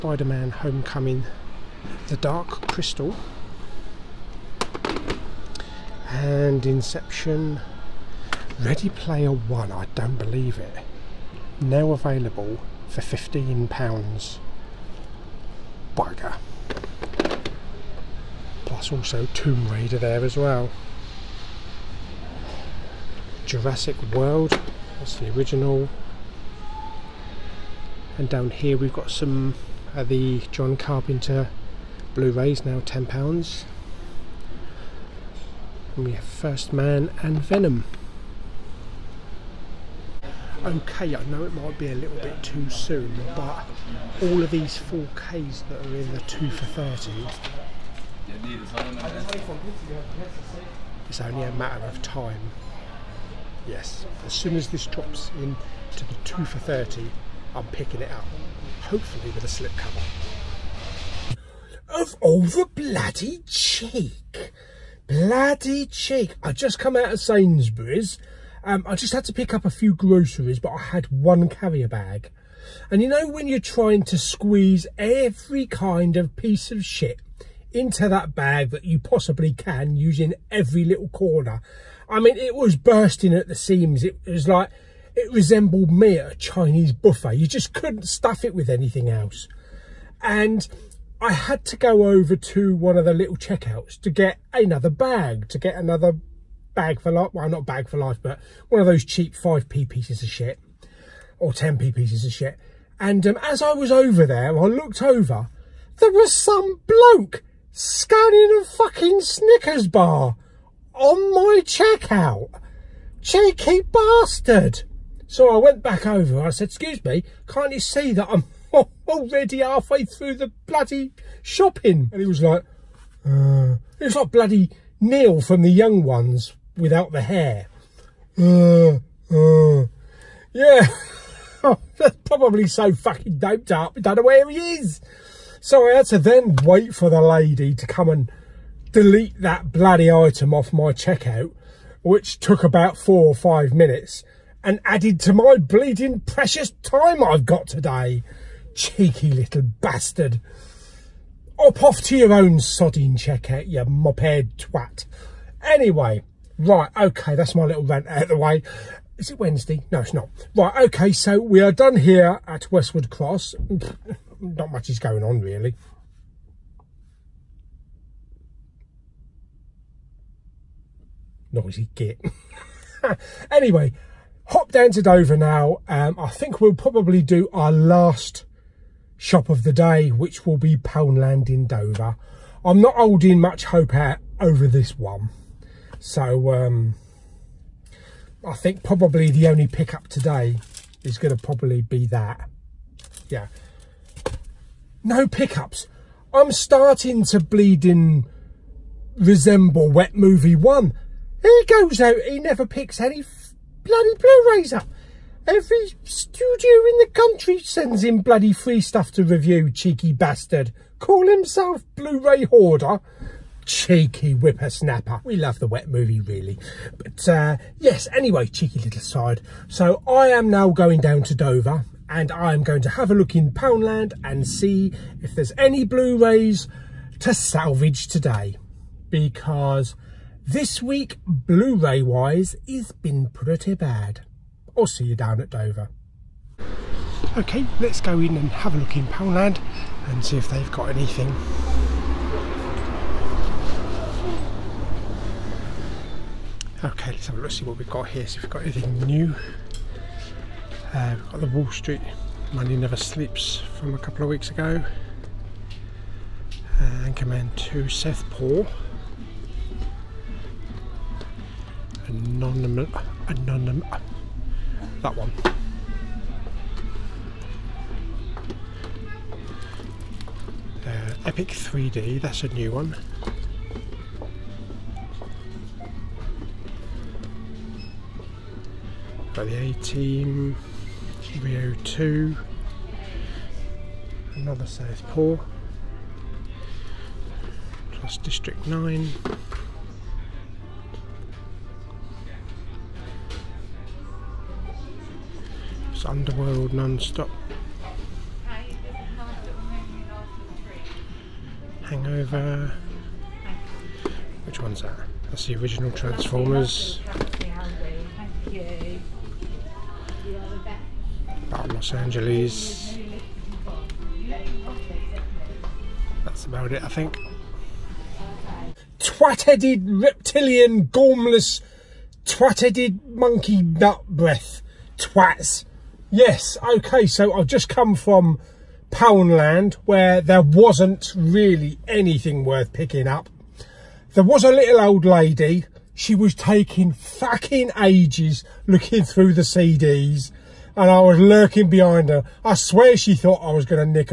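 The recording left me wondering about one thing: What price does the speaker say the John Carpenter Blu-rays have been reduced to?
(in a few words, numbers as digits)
£10.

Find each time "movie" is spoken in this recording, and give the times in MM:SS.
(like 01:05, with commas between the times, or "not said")
03:20, 03:35.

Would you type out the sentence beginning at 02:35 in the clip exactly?
Anyway, Right, okay, that's my little rant out of the way.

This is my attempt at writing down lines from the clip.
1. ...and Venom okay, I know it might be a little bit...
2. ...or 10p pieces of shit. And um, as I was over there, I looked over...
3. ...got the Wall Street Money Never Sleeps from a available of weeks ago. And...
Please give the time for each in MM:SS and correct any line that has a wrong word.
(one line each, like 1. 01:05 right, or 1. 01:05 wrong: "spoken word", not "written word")
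1. 00:37 right
2. 01:41 right
3. 04:11 wrong: "couple", not "available".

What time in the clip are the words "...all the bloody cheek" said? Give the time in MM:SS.
01:02.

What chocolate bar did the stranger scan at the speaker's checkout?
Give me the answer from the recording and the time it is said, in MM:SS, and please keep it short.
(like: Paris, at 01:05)
Snickers, at 01:49.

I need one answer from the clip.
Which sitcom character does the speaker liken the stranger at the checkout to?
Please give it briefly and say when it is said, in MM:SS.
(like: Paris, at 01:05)
Neil from The Young Ones, at 02:04.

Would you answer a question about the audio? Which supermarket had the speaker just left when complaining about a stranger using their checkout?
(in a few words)
Sainsbury's.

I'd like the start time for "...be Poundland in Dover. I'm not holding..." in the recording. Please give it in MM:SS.
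03:00.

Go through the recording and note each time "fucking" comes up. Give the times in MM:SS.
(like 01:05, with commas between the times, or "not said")
01:48, 02:12, 05:36.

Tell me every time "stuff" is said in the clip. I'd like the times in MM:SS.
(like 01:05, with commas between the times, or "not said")
01:28, 03:28.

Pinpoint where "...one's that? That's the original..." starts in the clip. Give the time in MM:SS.
05:04.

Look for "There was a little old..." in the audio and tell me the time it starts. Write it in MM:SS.
05:34.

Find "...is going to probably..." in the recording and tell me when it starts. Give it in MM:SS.
03:11.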